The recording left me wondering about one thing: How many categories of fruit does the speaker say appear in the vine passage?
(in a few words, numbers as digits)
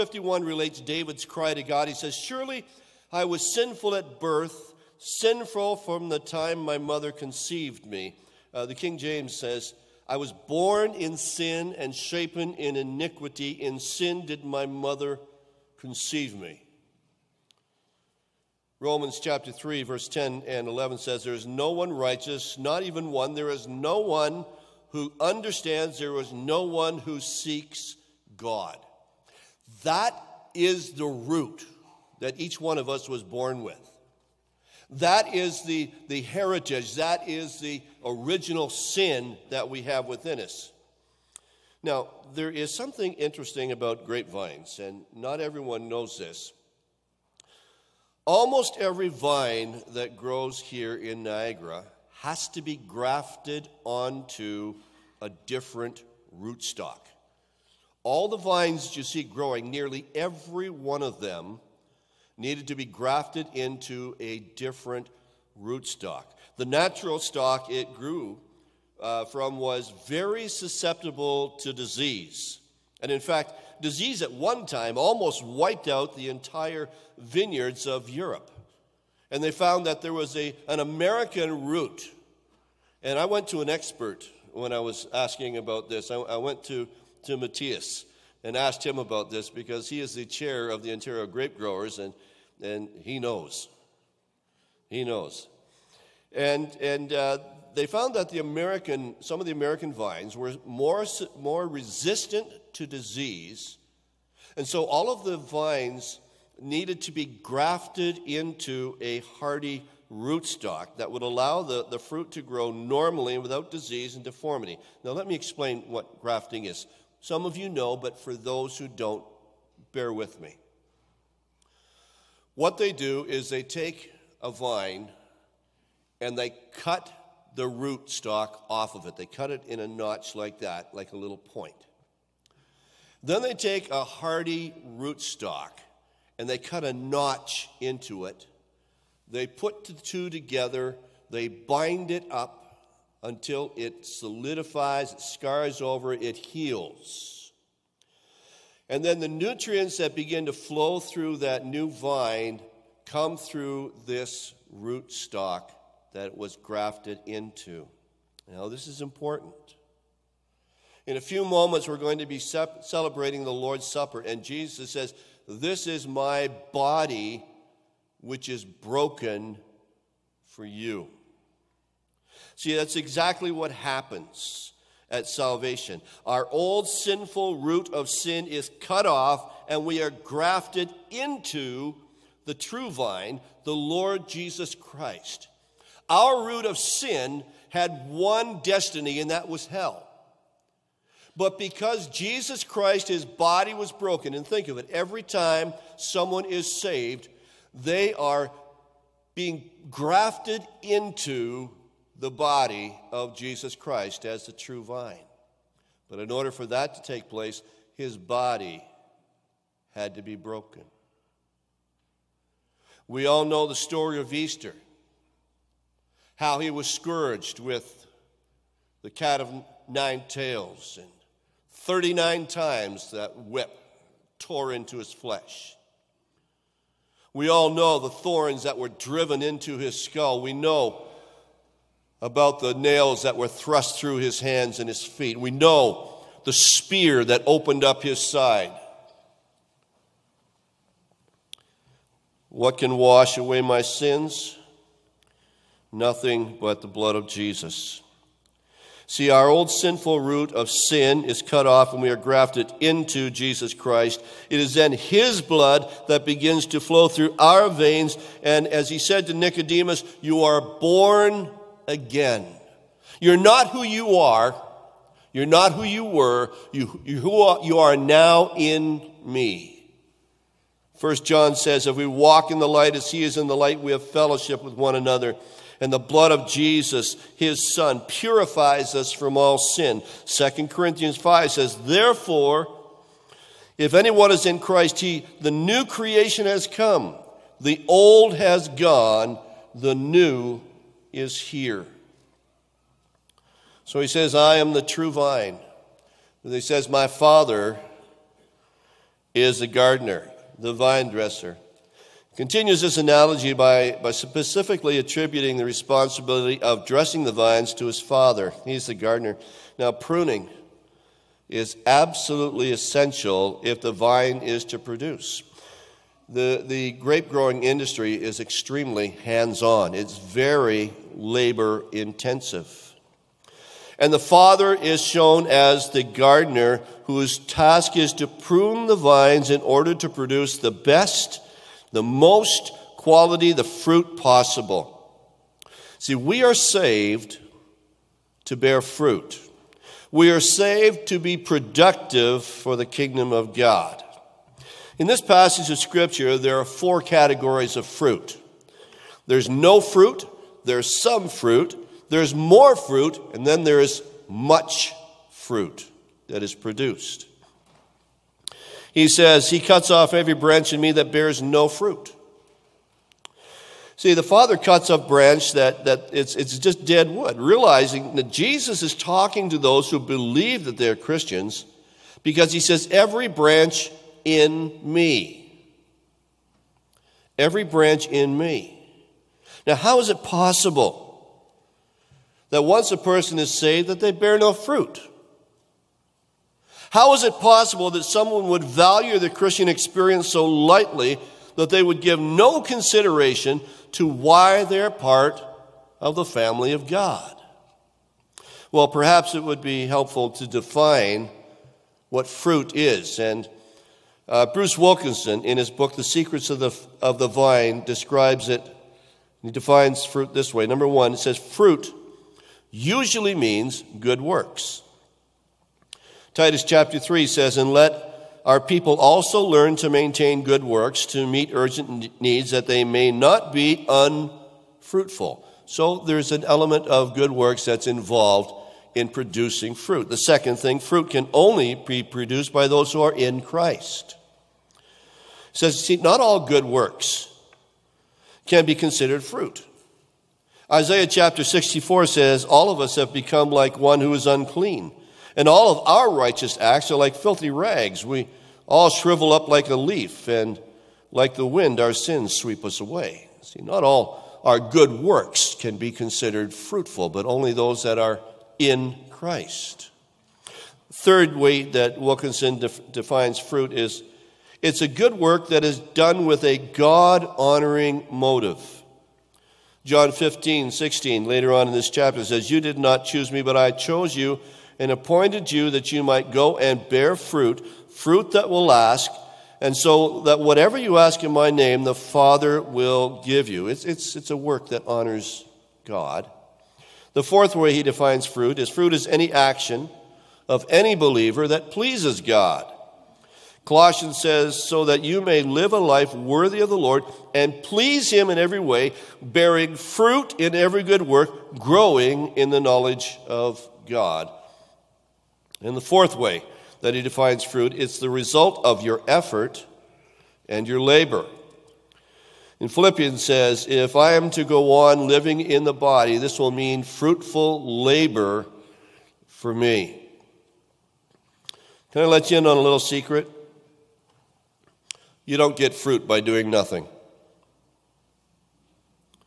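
4.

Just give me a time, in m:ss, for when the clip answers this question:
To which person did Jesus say
4:19.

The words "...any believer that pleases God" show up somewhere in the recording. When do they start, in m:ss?
8:10.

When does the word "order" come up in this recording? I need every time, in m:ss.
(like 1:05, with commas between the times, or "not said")
3:26, 5:29.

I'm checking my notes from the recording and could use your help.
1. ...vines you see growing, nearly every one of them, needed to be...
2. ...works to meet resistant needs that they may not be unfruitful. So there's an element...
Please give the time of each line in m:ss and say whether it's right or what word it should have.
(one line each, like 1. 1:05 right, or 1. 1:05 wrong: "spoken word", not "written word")
1. 0:58 right
2. 7:00 wrong: "urgent", not "resistant".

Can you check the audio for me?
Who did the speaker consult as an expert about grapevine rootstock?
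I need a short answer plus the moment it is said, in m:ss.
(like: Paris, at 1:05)
Matthias, at 1:27.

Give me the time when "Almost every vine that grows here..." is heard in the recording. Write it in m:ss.
0:48.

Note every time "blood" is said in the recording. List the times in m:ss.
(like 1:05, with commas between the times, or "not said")
4:06, 4:15, 4:35.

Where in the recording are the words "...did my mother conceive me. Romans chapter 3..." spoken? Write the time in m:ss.
0:14.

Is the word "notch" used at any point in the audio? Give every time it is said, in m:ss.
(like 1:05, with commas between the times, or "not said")
2:09, 2:16.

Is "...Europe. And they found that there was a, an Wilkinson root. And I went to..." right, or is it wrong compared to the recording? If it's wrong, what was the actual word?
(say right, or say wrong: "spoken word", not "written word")
wrong: "American", not "Wilkinson".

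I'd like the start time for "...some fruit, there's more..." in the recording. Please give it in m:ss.
5:51.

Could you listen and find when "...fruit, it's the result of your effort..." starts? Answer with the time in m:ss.
8:27.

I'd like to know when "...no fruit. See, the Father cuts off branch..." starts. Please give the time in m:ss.
6:01.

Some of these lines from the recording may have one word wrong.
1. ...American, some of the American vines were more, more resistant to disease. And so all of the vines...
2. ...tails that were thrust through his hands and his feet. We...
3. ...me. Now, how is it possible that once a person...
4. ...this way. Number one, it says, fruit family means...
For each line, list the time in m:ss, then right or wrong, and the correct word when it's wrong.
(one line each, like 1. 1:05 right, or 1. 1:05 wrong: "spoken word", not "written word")
1. 1:38 right
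2. 3:52 wrong: "nails", not "tails"
3. 6:18 right
4. 6:50 wrong: "usually", not "family".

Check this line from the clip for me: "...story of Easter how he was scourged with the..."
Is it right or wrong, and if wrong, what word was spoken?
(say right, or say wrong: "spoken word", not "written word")
right.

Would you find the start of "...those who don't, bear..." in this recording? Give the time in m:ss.
1:58.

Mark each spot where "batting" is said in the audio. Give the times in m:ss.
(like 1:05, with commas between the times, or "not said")
not said.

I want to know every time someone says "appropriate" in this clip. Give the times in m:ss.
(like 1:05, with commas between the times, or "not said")
not said.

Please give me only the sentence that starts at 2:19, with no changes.
They put the two together, they bind it up until it solidifies, it scars over, it heals.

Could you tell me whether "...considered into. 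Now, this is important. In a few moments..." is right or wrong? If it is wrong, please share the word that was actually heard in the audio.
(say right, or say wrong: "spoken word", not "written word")
wrong: "grafted", not "considered".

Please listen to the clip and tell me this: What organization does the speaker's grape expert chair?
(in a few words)
Ontario Grape Growers.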